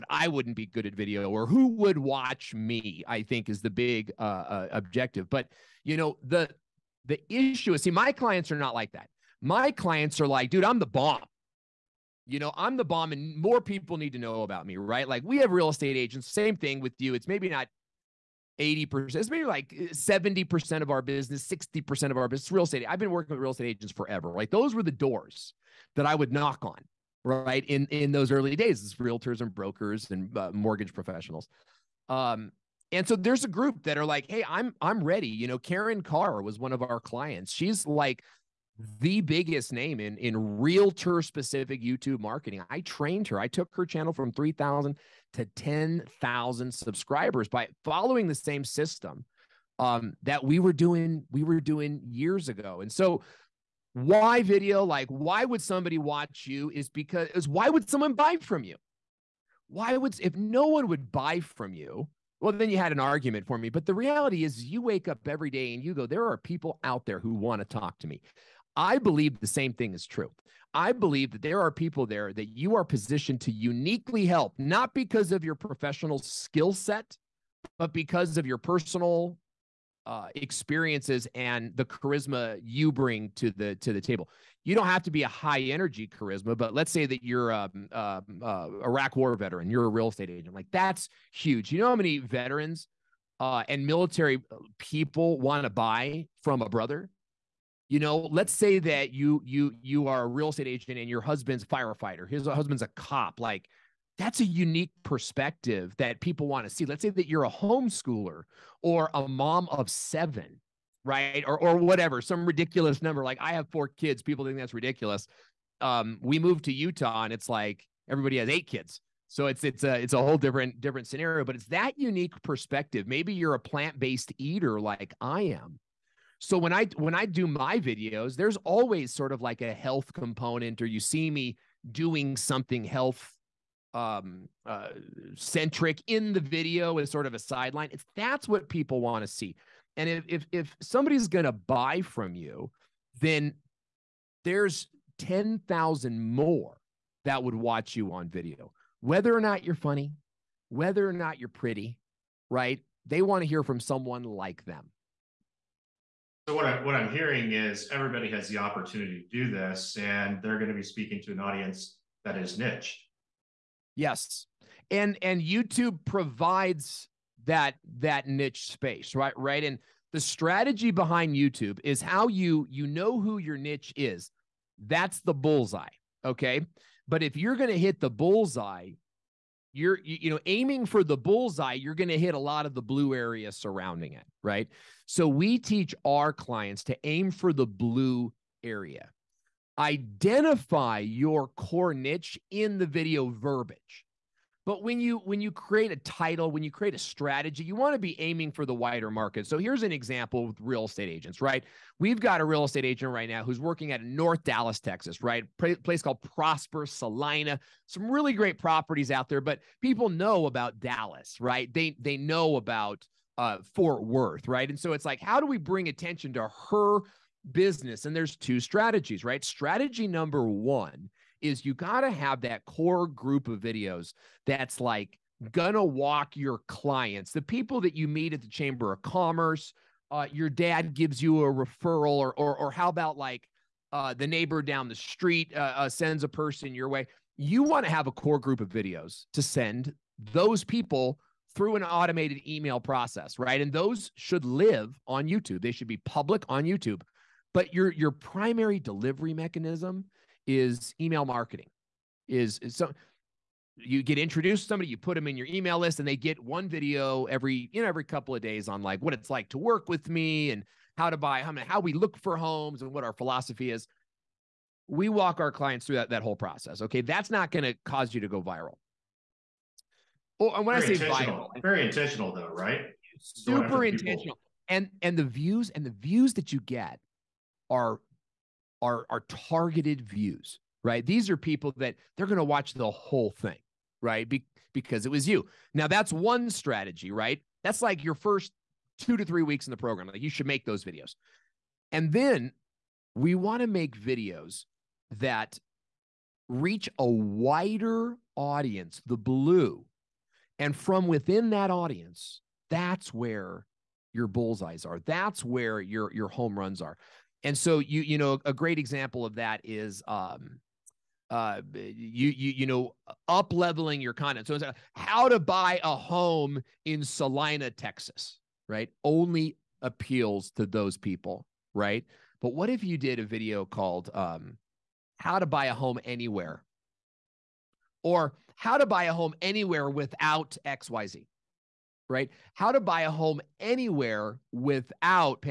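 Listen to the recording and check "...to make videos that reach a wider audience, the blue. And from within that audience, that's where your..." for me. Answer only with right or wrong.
right.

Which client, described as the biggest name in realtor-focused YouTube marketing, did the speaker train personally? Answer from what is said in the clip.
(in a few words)
Karen Carr.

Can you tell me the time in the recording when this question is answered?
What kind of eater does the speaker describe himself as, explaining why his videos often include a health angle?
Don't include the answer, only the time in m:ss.
2:03.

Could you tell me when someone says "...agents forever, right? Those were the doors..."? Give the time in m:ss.
0:23.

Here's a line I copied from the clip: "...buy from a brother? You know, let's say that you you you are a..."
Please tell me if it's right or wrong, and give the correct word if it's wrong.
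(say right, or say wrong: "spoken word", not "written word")
right.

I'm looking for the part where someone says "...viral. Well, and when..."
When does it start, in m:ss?
4:28.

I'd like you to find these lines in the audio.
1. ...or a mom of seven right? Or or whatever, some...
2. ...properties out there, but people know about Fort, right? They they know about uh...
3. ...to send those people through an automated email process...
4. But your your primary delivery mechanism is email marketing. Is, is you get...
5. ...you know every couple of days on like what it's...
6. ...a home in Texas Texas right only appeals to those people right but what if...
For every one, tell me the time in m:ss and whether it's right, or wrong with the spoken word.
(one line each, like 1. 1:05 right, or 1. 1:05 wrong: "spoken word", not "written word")
1. 1:48 right
2. 3:28 wrong: "Dallas", not "Fort"
3. 3:59 right
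4. 4:07 right
5. 4:17 right
6. 5:15 wrong: "Celina", not "Texas".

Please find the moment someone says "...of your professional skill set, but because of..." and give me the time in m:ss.
1:15.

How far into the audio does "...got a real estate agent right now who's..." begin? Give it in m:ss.
3:22.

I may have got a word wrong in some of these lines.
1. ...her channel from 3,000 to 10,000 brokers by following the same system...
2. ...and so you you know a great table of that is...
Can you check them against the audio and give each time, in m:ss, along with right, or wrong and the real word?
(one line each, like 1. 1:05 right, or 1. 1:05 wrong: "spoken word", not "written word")
1. 0:43 wrong: "subscribers", not "brokers"
2. 5:07 wrong: "example", not "table".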